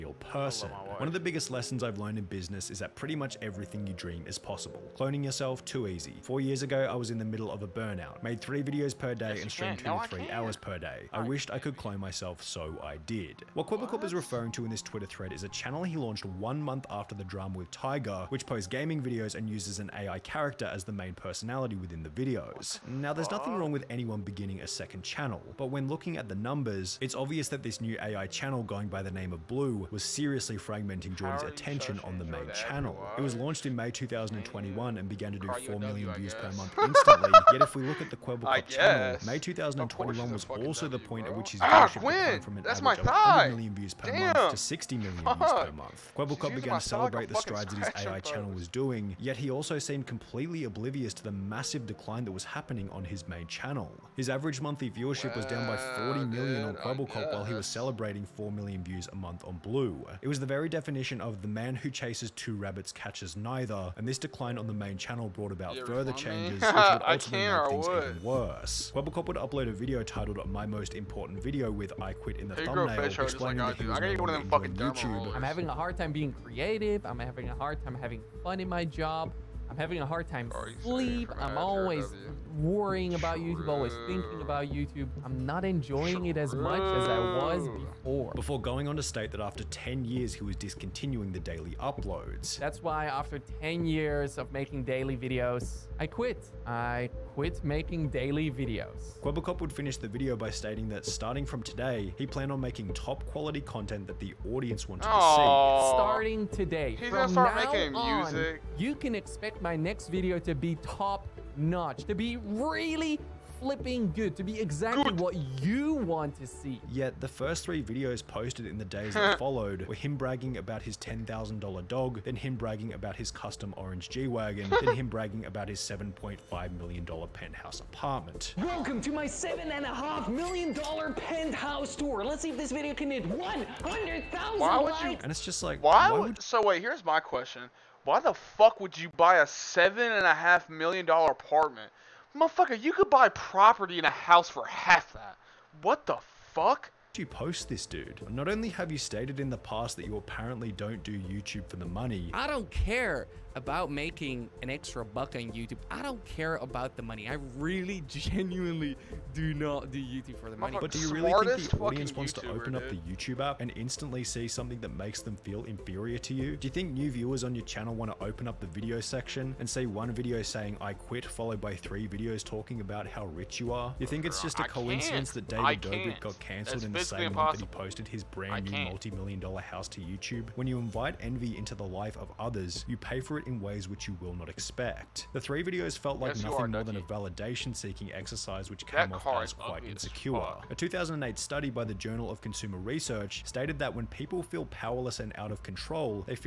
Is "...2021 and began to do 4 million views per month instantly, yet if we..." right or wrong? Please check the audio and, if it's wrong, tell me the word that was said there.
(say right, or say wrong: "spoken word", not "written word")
right.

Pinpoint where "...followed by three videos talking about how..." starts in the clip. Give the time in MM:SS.
02:51.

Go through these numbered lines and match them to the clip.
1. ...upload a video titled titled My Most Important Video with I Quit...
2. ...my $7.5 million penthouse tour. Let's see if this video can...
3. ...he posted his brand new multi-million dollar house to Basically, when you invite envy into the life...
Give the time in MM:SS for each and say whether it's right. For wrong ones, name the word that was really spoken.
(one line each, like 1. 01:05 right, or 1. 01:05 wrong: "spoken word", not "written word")
1. 01:09 right
2. 02:09 right
3. 02:57 wrong: "YouTube", not "Basically".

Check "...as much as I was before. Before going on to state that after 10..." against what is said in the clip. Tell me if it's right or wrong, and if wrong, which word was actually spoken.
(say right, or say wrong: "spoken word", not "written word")
right.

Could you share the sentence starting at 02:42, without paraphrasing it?
up the YouTube app and instantly see something that makes them feel inferior to you?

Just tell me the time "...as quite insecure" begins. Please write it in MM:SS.
03:09.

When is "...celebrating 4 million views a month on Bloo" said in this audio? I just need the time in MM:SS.
00:57.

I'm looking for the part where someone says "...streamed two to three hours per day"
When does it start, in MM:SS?
00:09.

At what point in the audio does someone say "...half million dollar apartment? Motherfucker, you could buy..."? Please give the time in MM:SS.
02:20.